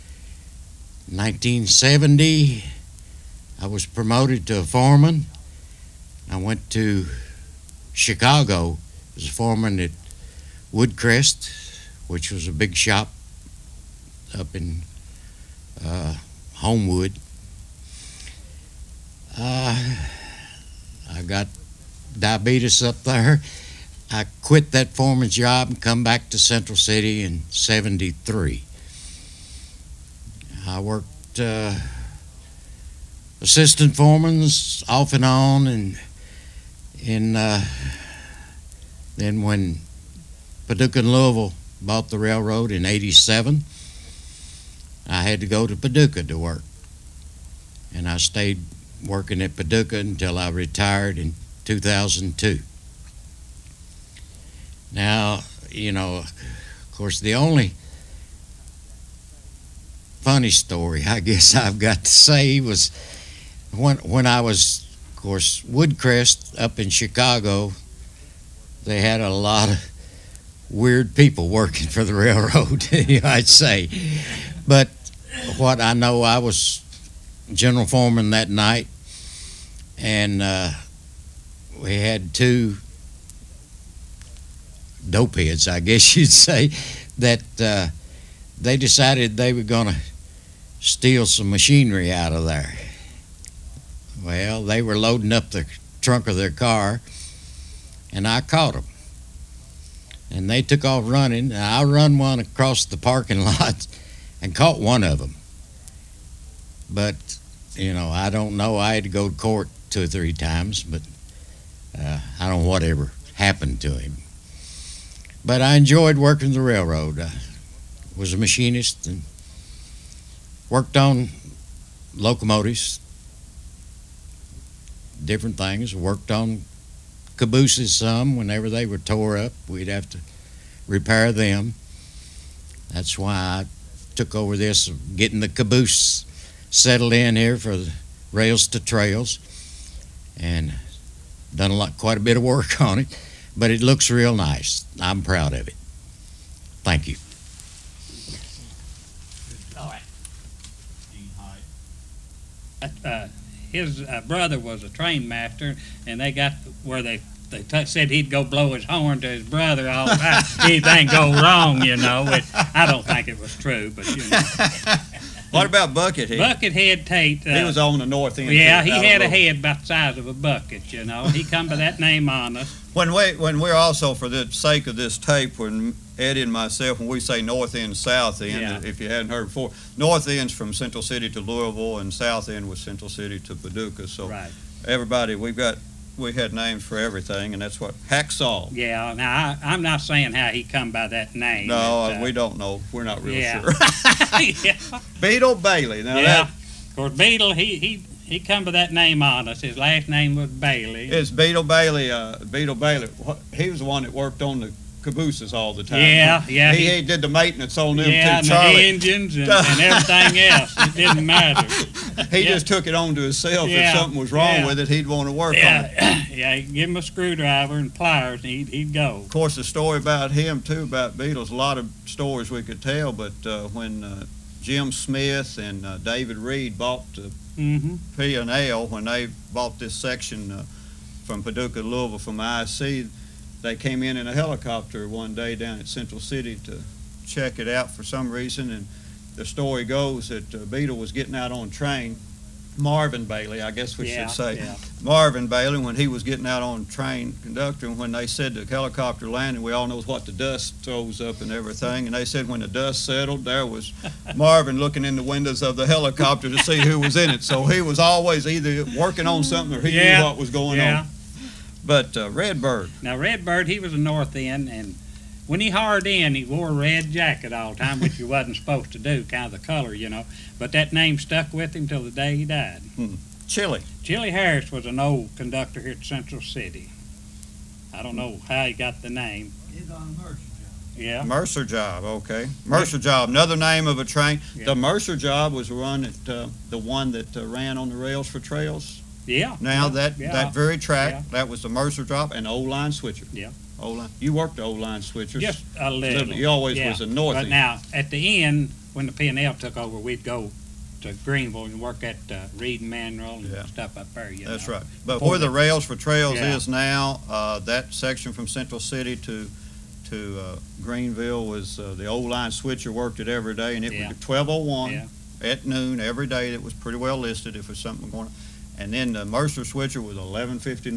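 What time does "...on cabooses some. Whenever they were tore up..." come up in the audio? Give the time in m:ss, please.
2:06.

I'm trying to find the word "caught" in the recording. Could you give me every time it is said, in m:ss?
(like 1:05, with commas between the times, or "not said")
1:38, 1:44.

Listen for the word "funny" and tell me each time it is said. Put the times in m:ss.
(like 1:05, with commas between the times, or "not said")
1:00.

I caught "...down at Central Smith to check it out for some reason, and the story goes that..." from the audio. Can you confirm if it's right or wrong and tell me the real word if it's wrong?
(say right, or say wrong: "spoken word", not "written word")
wrong: "City", not "Smith".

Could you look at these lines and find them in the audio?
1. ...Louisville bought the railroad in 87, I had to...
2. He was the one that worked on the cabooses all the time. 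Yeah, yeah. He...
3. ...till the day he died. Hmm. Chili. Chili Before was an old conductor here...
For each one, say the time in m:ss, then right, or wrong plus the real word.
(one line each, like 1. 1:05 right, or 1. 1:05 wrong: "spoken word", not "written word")
1. 0:41 right
2. 3:23 right
3. 4:31 wrong: "Harris", not "Before".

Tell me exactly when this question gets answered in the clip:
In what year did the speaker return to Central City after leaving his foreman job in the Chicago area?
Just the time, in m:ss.
0:27.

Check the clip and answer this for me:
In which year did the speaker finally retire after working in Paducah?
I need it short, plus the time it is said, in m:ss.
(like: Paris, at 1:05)
2002, at 0:51.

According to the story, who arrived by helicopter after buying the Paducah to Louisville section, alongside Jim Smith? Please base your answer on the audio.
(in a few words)
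David Reed.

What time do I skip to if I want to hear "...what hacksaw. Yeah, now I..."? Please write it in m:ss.
3:07.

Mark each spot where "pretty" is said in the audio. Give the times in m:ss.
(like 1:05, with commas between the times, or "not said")
5:16.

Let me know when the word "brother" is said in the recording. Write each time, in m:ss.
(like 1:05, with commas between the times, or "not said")
2:34, 2:39.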